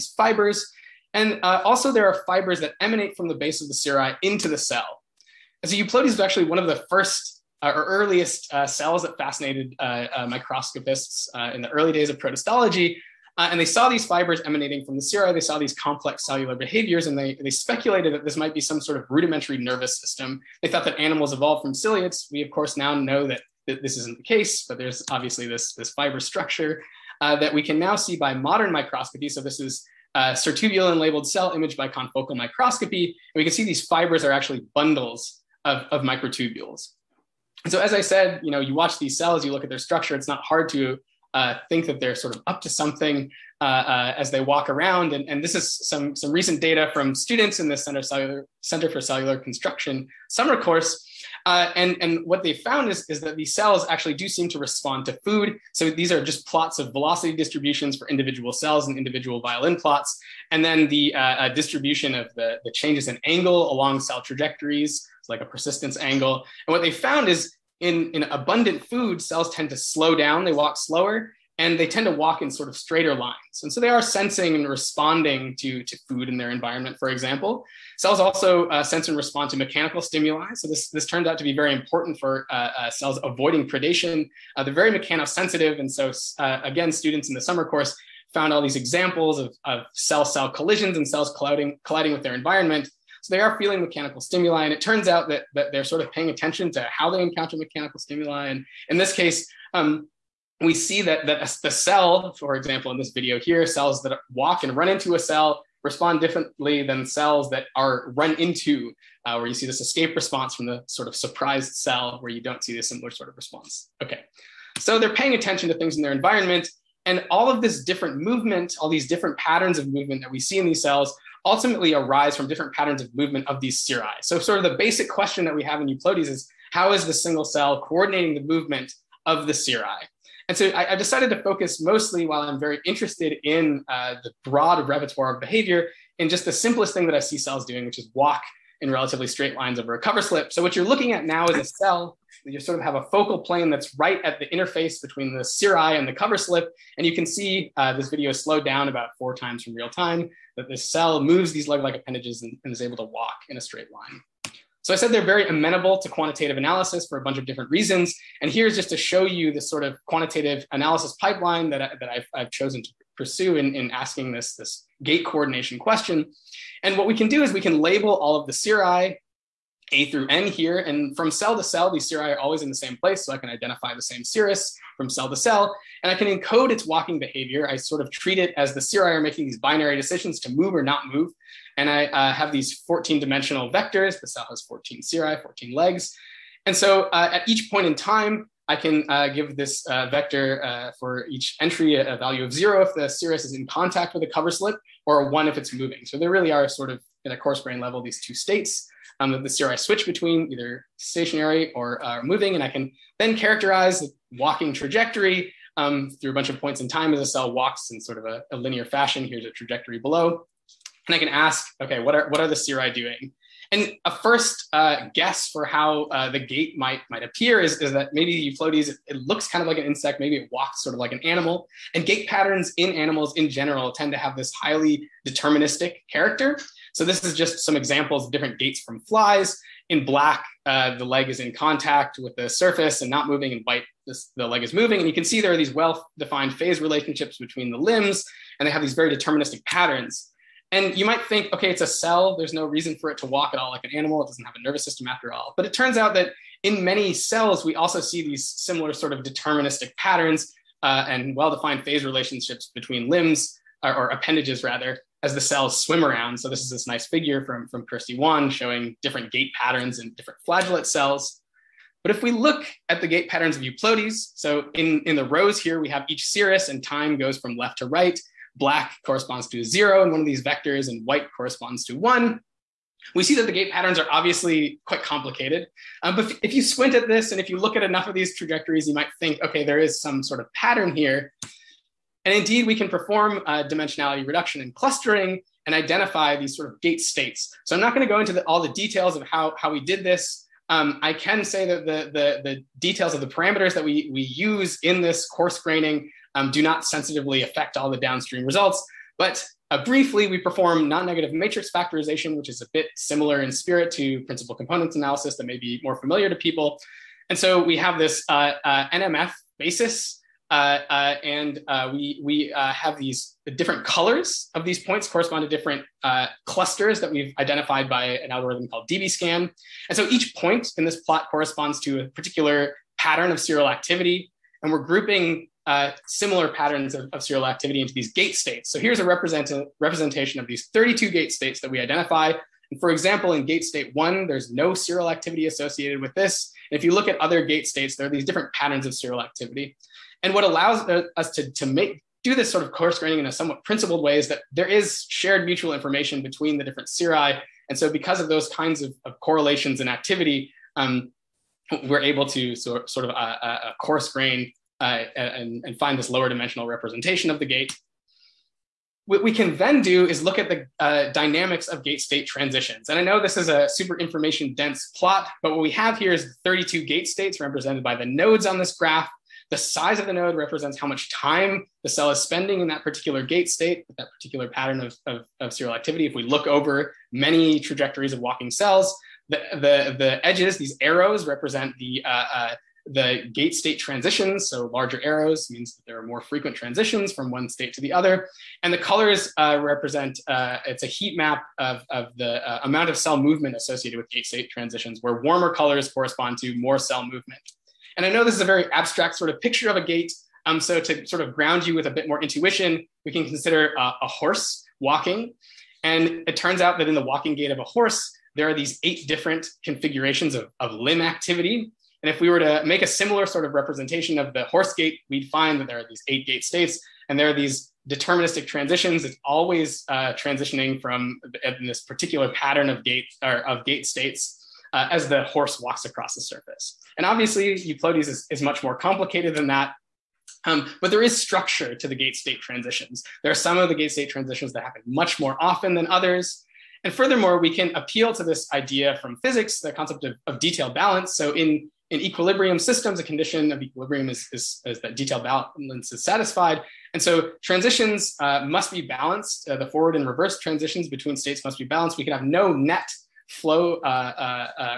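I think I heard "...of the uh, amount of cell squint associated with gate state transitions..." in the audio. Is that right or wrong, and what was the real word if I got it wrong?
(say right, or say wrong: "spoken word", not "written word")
wrong: "movement", not "squint".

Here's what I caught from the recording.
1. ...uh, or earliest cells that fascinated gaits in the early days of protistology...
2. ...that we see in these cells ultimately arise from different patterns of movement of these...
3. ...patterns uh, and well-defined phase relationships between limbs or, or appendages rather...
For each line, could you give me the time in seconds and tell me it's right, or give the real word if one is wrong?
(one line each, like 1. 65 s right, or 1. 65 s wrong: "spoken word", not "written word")
1. 7 s wrong: "microscopists", not "gaits"
2. 120 s right
3. 249 s right.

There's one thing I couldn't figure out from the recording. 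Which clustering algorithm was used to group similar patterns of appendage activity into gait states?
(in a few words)
DBSCAN.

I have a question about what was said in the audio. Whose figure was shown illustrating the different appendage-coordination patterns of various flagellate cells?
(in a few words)
Kirsty Wan.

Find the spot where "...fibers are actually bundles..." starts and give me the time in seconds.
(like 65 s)
33 s.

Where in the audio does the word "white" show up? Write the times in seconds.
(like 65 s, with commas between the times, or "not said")
233 s, 271 s.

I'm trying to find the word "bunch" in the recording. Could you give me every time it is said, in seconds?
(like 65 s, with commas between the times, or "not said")
157 s, 206 s.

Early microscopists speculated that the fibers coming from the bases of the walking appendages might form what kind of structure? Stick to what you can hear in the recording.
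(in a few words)
Rudimentary nervous system.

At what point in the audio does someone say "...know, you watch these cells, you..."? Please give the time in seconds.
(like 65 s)
38 s.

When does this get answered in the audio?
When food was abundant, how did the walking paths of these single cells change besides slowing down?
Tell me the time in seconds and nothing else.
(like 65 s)
72 s.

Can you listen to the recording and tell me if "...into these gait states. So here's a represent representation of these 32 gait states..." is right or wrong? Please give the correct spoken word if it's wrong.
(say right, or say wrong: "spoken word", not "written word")
right.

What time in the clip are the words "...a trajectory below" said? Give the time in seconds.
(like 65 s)
209 s.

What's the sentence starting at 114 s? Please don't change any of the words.
Okay, so they're paying attention to things in their environment.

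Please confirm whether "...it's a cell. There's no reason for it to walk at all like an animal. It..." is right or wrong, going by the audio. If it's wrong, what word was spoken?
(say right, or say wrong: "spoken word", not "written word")
right.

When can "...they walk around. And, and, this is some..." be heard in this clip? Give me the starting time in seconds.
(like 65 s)
44 s.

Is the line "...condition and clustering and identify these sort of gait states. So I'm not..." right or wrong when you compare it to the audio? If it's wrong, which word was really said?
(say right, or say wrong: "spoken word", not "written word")
wrong: "reduction", not "condition".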